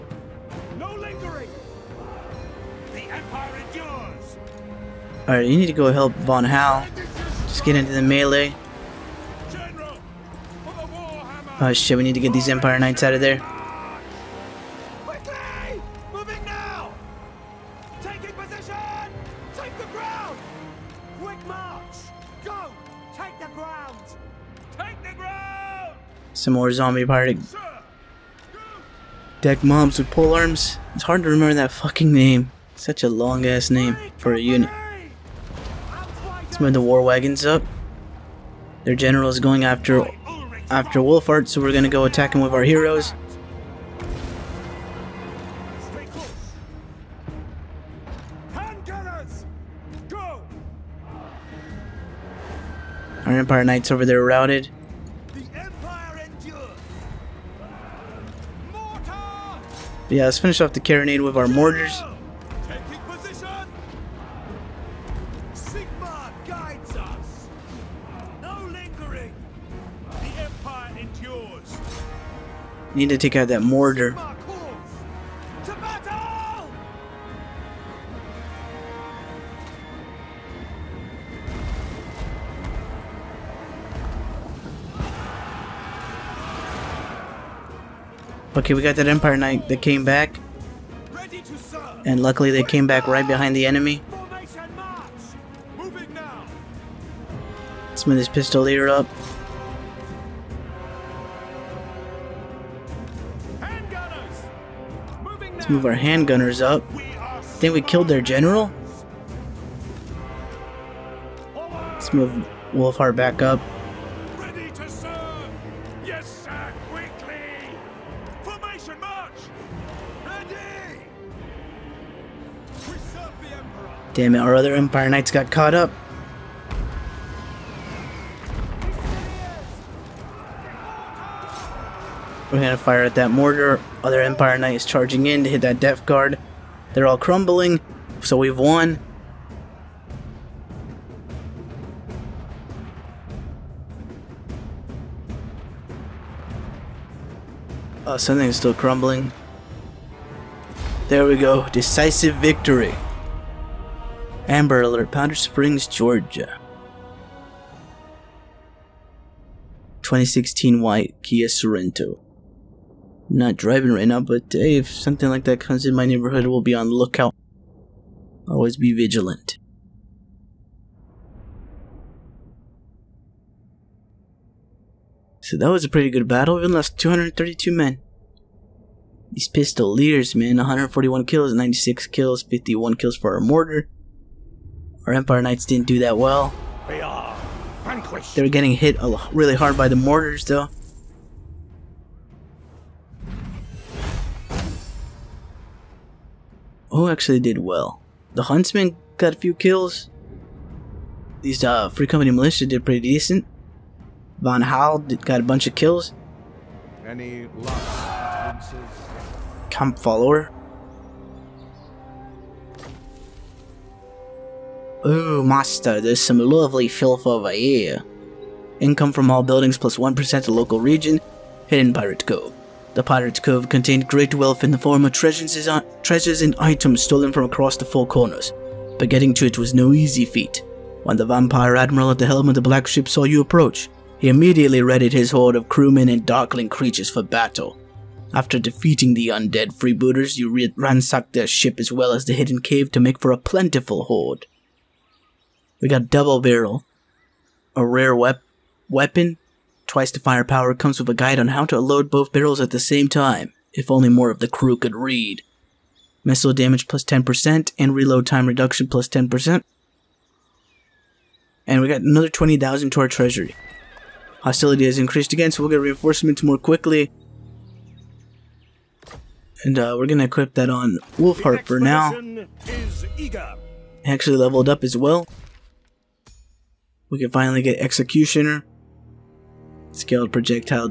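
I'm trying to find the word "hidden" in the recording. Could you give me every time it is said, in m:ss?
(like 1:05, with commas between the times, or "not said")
3:41, 4:02.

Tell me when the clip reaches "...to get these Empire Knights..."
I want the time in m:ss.
0:12.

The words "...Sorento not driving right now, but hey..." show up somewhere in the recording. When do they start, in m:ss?
2:41.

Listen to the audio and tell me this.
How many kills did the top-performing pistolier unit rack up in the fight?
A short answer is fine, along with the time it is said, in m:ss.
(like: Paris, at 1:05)
141, at 3:00.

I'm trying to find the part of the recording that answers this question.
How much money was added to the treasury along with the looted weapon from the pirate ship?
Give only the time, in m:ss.
4:22.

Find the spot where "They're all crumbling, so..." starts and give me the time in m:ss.
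2:16.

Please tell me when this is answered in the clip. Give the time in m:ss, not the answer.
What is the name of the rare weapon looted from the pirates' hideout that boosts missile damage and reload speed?
4:06.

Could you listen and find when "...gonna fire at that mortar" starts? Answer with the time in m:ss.
2:12.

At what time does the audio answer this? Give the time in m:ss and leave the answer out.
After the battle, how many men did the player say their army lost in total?
2:56.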